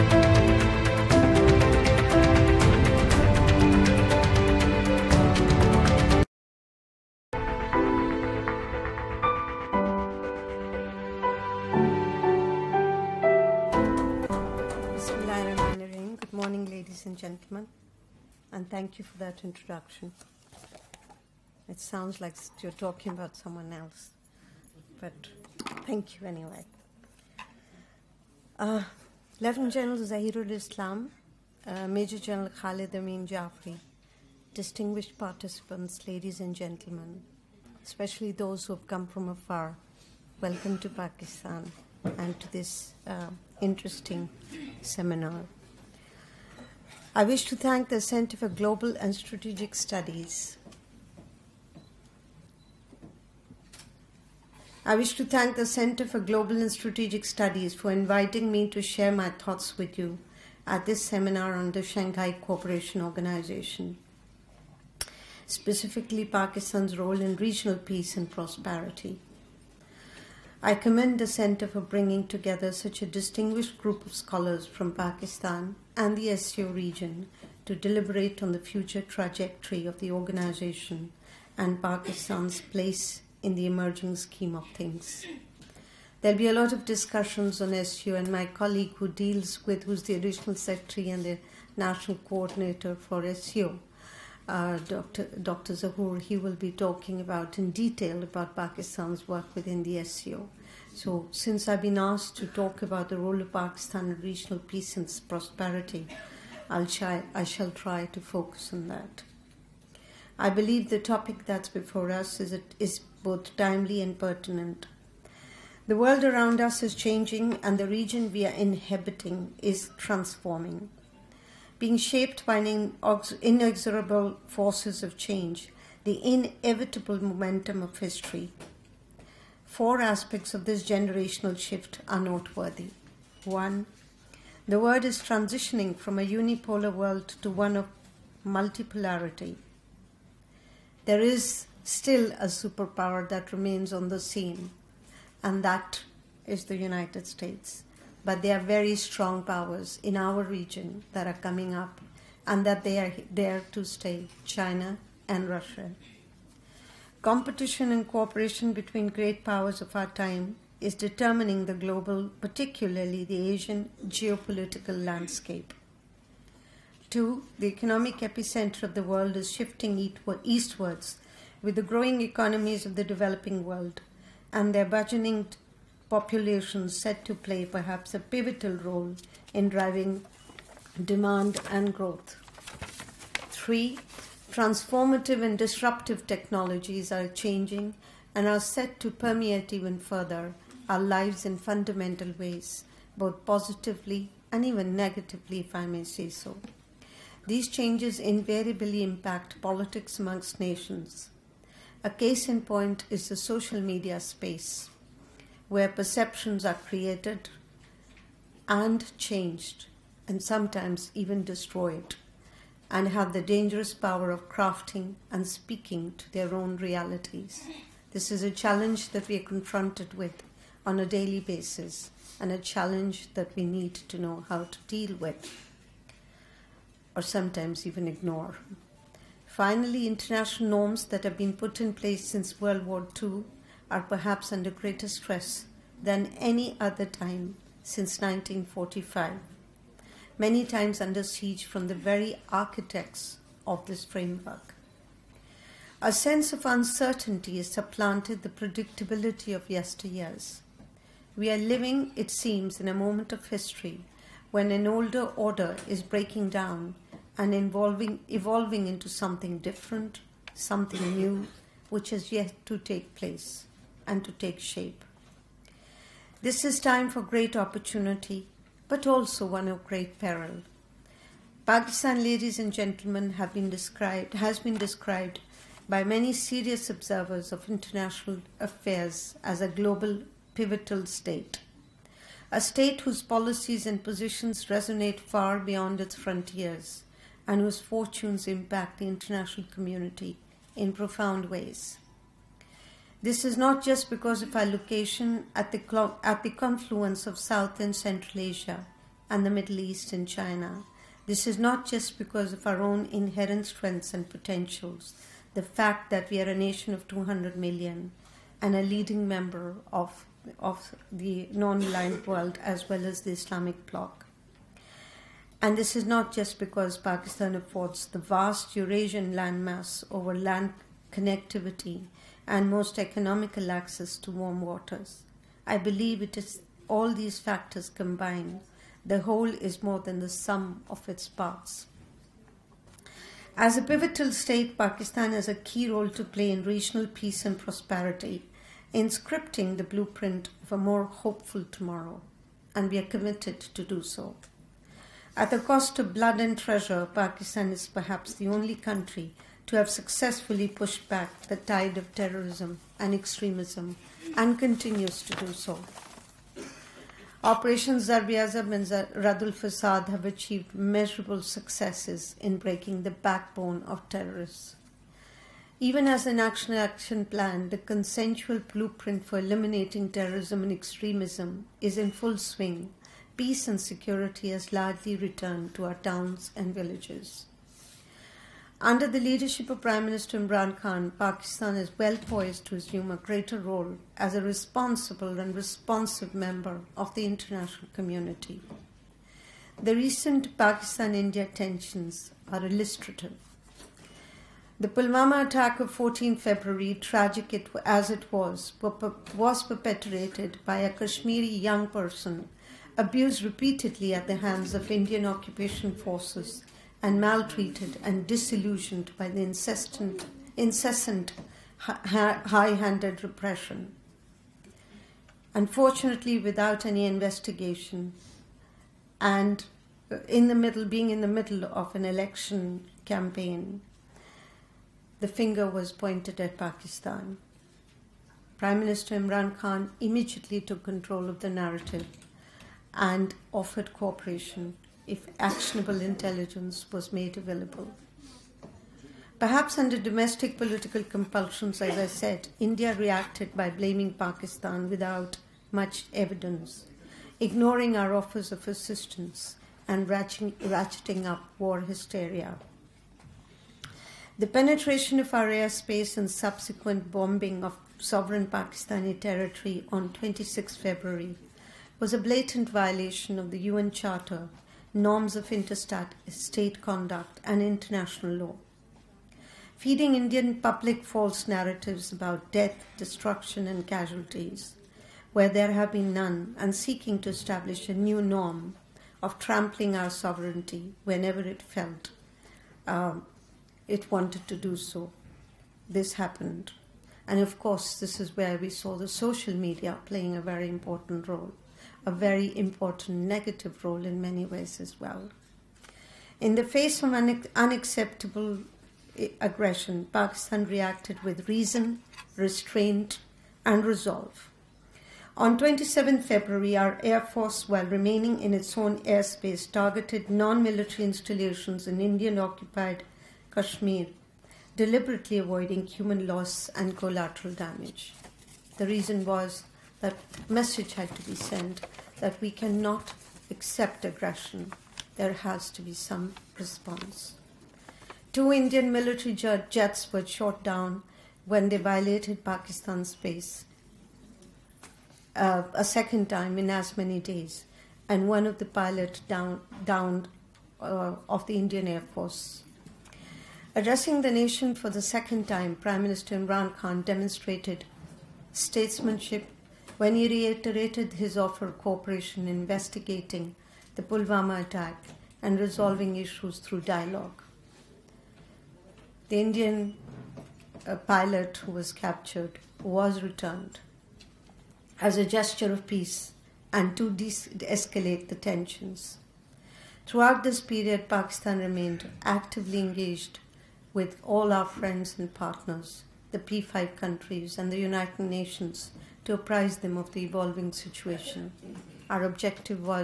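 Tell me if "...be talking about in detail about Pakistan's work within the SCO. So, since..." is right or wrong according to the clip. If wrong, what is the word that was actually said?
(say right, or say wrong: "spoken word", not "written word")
right.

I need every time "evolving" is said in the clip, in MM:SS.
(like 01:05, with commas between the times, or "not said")
04:17, 09:40.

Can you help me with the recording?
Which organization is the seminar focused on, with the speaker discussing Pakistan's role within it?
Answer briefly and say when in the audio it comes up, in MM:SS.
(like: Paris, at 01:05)
Shanghai Cooperation Organization, at 01:01.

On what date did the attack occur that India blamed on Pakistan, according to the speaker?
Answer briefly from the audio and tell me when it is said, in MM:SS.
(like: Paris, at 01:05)
14 February, at 06:35.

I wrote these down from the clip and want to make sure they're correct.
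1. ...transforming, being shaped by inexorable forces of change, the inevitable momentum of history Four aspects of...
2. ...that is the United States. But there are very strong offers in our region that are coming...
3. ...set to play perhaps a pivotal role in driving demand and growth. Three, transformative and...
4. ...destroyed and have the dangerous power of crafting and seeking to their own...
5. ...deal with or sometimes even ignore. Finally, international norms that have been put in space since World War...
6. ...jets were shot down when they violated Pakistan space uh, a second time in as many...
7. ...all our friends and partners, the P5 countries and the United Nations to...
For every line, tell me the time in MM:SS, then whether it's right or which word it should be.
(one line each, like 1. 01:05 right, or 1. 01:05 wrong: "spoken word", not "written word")
1. 01:59 right
2. 02:25 wrong: "powers", not "offers"
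3. 02:56 right
4. 03:31 wrong: "speaking", not "seeking"
5. 03:44 wrong: "place", not "space"
6. 08:49 right
7. 09:34 right.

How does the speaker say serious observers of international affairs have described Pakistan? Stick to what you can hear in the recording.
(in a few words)
Global pivotal state.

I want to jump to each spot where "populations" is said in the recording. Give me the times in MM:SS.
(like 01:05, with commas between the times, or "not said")
02:56.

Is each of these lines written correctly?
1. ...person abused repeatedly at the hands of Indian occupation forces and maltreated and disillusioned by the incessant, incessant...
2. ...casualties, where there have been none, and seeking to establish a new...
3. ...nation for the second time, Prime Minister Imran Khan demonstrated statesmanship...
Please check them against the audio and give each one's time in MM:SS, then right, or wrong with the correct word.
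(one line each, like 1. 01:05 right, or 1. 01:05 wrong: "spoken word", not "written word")
1. 06:41 right
2. 07:53 right
3. 09:04 right.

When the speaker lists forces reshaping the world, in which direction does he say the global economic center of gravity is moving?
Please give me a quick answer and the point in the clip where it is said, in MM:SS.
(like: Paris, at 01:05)
Eastwards, at 02:50.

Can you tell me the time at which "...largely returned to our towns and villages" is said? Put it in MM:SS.
06:14.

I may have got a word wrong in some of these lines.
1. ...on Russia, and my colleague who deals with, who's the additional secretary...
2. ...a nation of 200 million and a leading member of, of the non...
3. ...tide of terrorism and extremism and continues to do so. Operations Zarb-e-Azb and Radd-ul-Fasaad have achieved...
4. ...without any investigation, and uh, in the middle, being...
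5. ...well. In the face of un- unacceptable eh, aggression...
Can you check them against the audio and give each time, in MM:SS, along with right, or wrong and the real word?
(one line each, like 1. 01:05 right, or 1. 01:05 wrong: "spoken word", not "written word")
1. 01:27 wrong: "SCO", not "Russia"
2. 05:06 right
3. 05:51 right
4. 06:56 right
5. 08:14 right.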